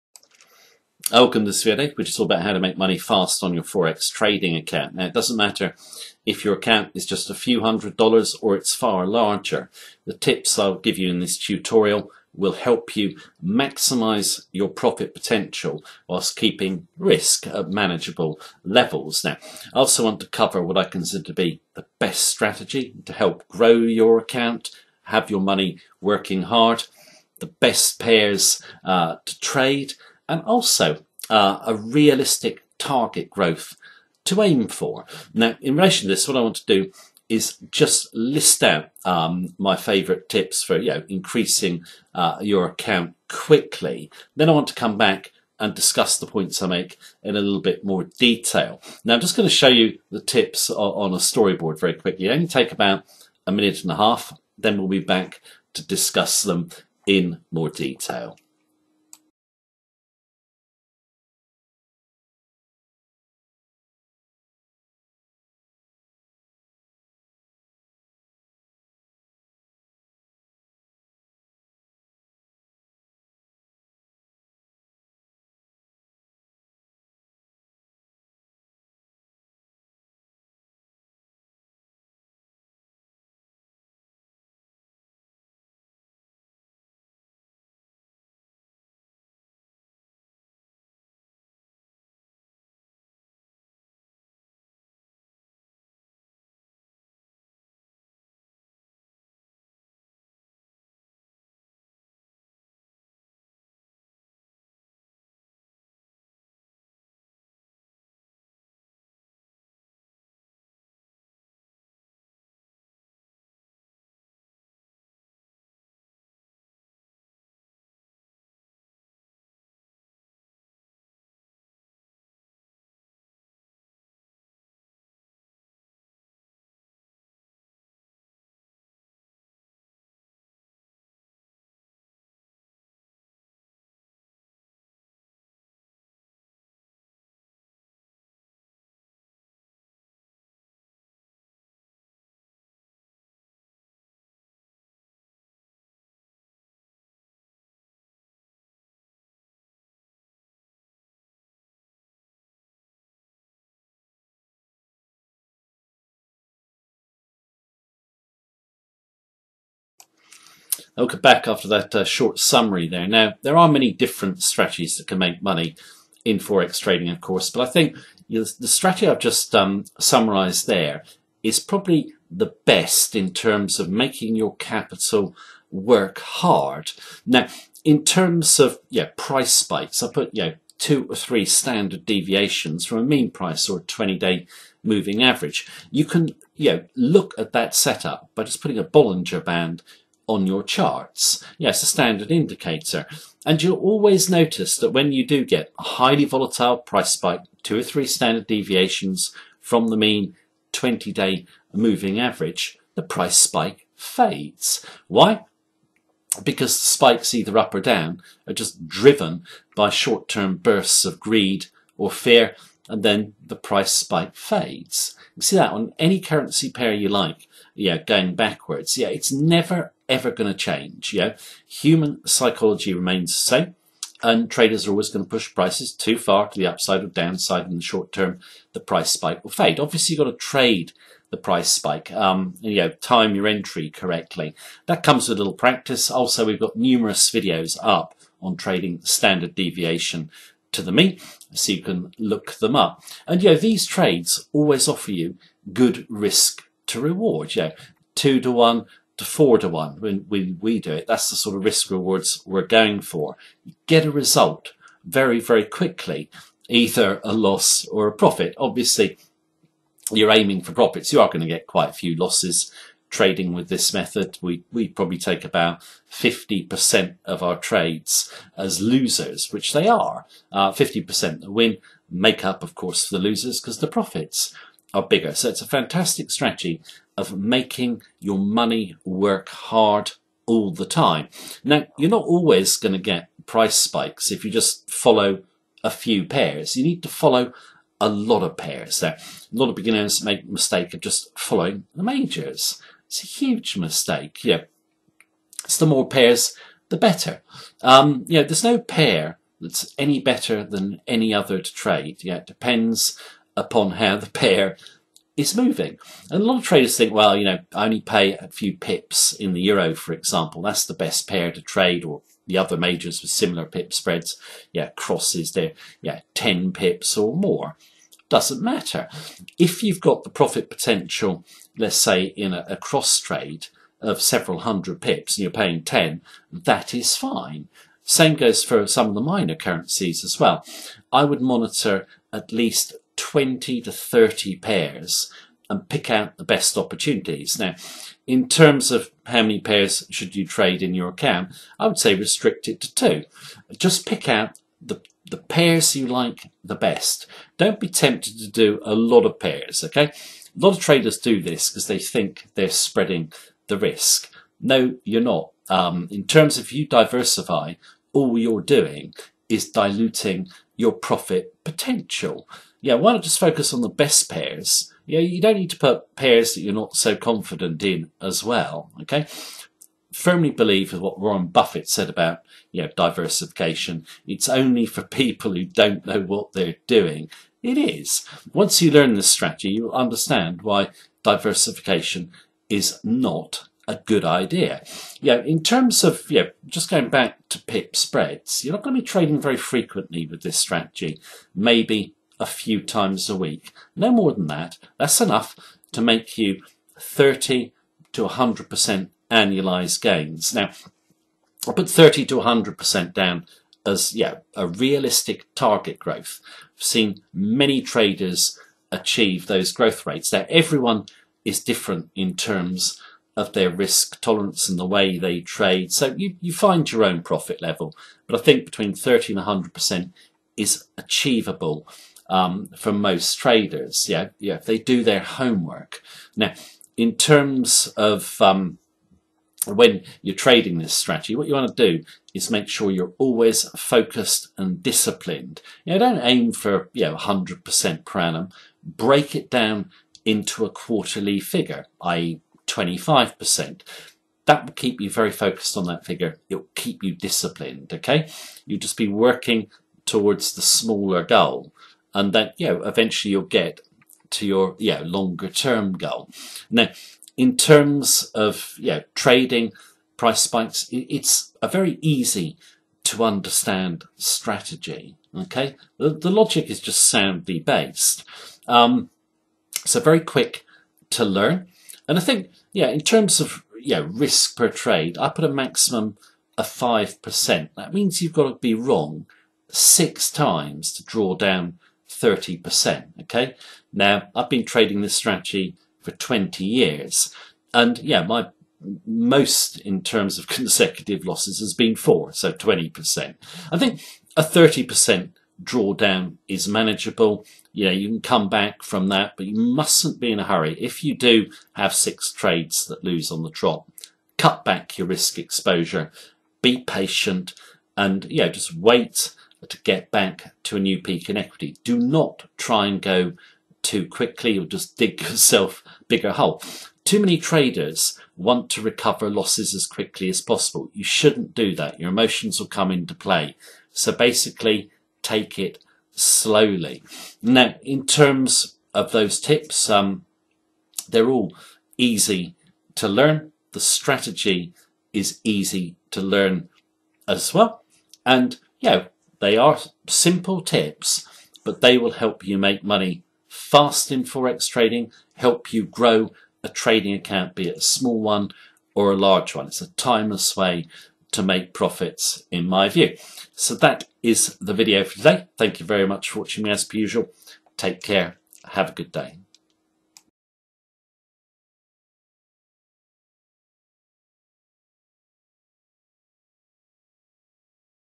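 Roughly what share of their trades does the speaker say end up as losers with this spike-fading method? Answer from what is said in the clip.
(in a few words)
50%.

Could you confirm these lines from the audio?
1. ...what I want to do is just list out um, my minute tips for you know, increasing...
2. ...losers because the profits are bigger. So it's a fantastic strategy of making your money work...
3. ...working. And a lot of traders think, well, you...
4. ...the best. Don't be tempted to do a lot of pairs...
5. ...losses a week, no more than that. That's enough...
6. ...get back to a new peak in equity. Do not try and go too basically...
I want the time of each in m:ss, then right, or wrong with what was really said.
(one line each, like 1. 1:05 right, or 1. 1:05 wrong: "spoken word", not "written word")
1. 0:36 wrong: "favourite", not "minute"
2. 4:33 right
3. 5:05 wrong: "moving", not "working"
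4. 5:46 right
5. 6:32 wrong: "times", not "losses"
6. 8:29 wrong: "quickly", not "basically".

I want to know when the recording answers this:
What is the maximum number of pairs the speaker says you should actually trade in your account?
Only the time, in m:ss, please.
5:42.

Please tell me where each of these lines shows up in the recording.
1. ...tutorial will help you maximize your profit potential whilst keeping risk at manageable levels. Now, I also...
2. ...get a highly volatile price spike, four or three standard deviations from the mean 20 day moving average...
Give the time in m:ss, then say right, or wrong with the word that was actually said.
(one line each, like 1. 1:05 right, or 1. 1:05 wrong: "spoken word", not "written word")
1. 0:11 right
2. 3:15 wrong: "two", not "four".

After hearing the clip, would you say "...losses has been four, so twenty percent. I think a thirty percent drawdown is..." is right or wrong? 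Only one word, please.
right.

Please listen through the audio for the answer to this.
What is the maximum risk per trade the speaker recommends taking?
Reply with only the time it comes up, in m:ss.
7:56.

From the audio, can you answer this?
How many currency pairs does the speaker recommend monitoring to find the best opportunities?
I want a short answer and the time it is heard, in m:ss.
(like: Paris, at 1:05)
20 to 30, at 5:33.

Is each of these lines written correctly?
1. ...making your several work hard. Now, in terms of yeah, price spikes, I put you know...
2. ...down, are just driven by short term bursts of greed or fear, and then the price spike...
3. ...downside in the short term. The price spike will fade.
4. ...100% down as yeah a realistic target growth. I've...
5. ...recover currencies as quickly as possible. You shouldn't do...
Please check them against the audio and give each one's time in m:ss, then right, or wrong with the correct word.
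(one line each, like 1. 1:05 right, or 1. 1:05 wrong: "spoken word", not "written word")
1. 2:53 wrong: "capital", not "several"
2. 3:27 right
3. 3:47 right
4. 6:42 right
5. 8:38 wrong: "losses", not "currencies".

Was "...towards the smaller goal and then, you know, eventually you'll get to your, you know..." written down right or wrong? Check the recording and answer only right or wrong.
right.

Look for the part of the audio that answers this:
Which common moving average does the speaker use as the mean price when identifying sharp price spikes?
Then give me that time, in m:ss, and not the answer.
3:03.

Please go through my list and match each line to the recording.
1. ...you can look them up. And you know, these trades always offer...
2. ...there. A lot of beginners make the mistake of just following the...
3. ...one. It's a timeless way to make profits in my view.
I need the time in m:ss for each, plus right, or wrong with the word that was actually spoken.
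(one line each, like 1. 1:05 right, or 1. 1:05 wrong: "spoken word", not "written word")
1. 4:01 right
2. 4:48 right
3. 9:09 right.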